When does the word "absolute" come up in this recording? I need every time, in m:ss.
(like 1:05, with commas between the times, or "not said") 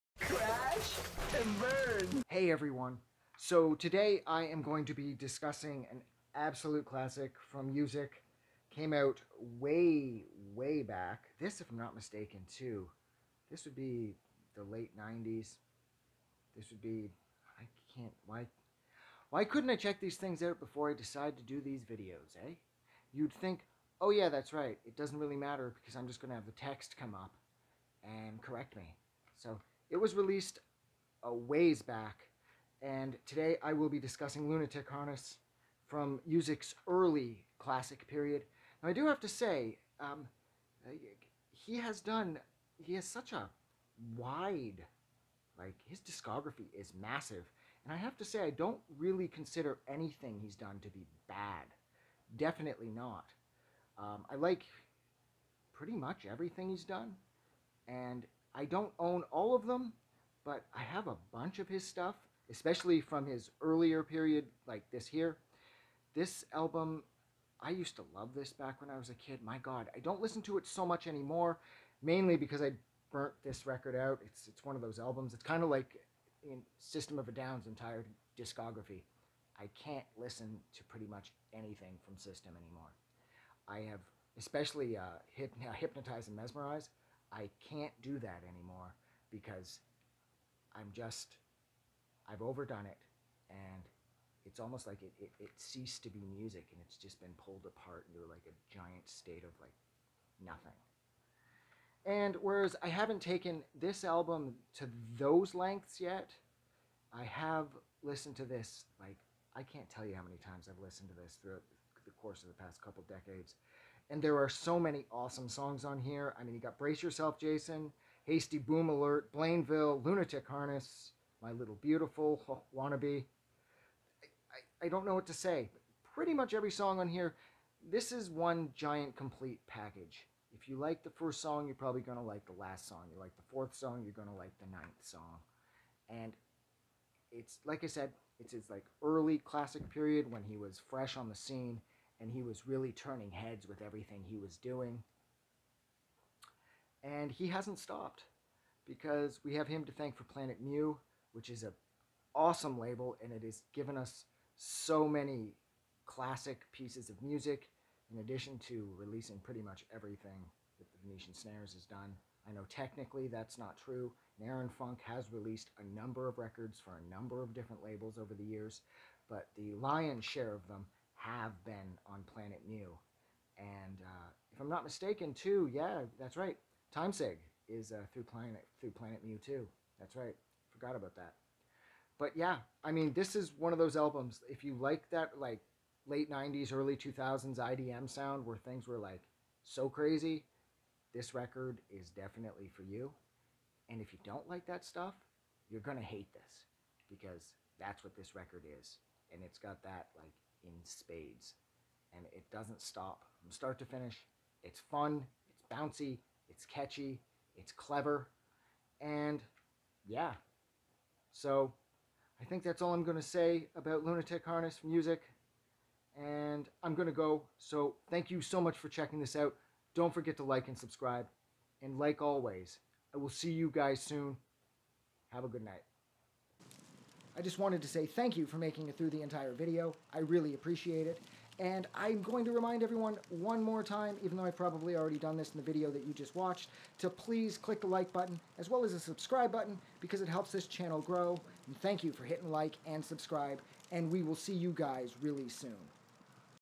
0:06.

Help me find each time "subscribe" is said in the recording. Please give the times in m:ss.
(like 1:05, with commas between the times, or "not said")
3:40, 3:58, 4:03.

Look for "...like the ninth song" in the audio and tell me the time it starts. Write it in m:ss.
2:14.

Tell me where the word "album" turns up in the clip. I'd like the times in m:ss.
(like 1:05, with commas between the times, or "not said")
1:06, 1:14, 1:44, 3:03.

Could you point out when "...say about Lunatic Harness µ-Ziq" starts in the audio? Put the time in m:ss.
3:33.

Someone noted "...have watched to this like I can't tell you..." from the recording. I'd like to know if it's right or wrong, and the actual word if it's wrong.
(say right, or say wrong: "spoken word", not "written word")
wrong: "listened", not "watched".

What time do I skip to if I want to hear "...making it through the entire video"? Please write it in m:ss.
3:48.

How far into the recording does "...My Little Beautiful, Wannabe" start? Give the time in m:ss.
2:01.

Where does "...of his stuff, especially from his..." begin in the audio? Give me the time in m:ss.
1:01.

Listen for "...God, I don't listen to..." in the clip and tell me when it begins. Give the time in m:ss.
1:09.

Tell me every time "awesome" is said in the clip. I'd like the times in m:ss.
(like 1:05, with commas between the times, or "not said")
1:55, 2:32.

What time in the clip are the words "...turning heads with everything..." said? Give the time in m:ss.
2:22.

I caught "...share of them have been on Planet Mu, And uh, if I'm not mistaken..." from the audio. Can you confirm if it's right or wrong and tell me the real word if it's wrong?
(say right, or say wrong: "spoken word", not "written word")
right.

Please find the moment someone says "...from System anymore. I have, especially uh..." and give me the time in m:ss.
1:22.